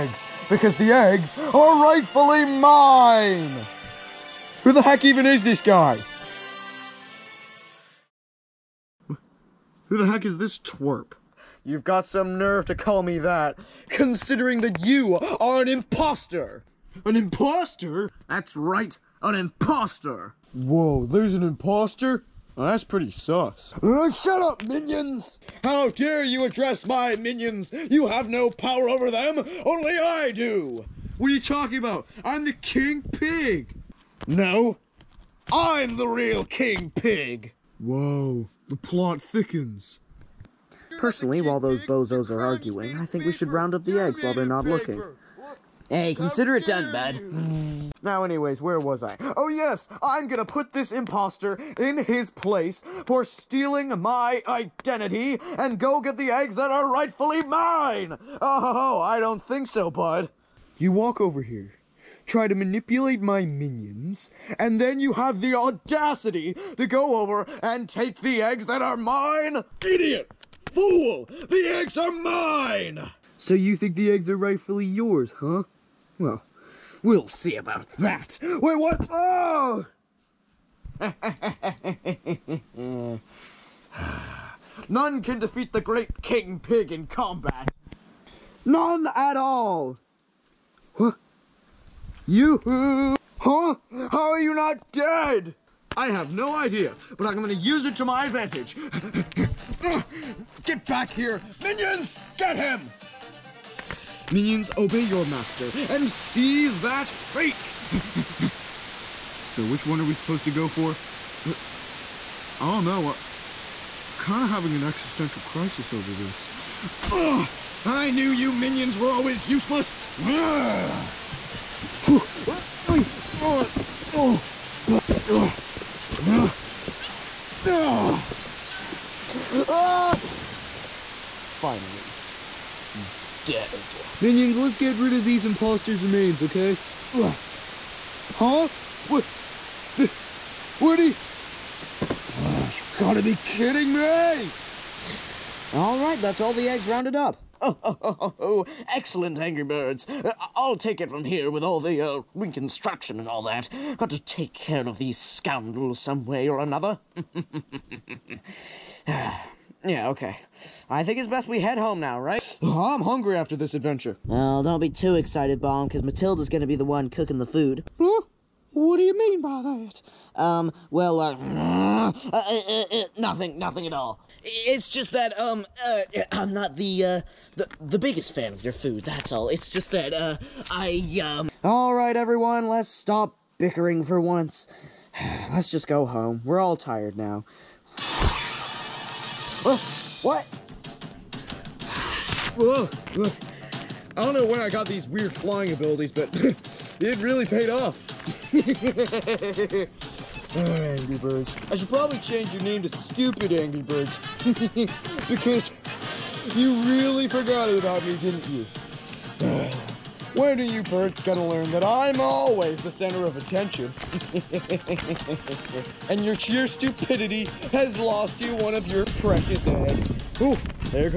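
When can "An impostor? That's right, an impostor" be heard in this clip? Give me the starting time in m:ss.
0:17.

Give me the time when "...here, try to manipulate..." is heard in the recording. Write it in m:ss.
1:01.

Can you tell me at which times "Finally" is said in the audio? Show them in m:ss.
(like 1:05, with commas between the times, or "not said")
2:11.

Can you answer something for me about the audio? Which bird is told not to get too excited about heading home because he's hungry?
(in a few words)
Bomb.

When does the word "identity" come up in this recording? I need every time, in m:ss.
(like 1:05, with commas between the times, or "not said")
0:54.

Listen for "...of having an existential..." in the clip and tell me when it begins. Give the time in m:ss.
1:54.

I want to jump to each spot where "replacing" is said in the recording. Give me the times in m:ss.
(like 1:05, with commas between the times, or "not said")
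not said.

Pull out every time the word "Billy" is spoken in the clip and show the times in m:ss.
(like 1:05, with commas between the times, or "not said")
not said.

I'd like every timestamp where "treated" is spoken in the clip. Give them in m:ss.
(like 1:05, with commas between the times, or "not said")
not said.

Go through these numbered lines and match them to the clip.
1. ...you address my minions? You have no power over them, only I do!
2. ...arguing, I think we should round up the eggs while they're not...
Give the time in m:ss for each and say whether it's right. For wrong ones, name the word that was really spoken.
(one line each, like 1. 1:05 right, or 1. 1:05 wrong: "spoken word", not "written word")
1. 0:26 right
2. 0:42 right.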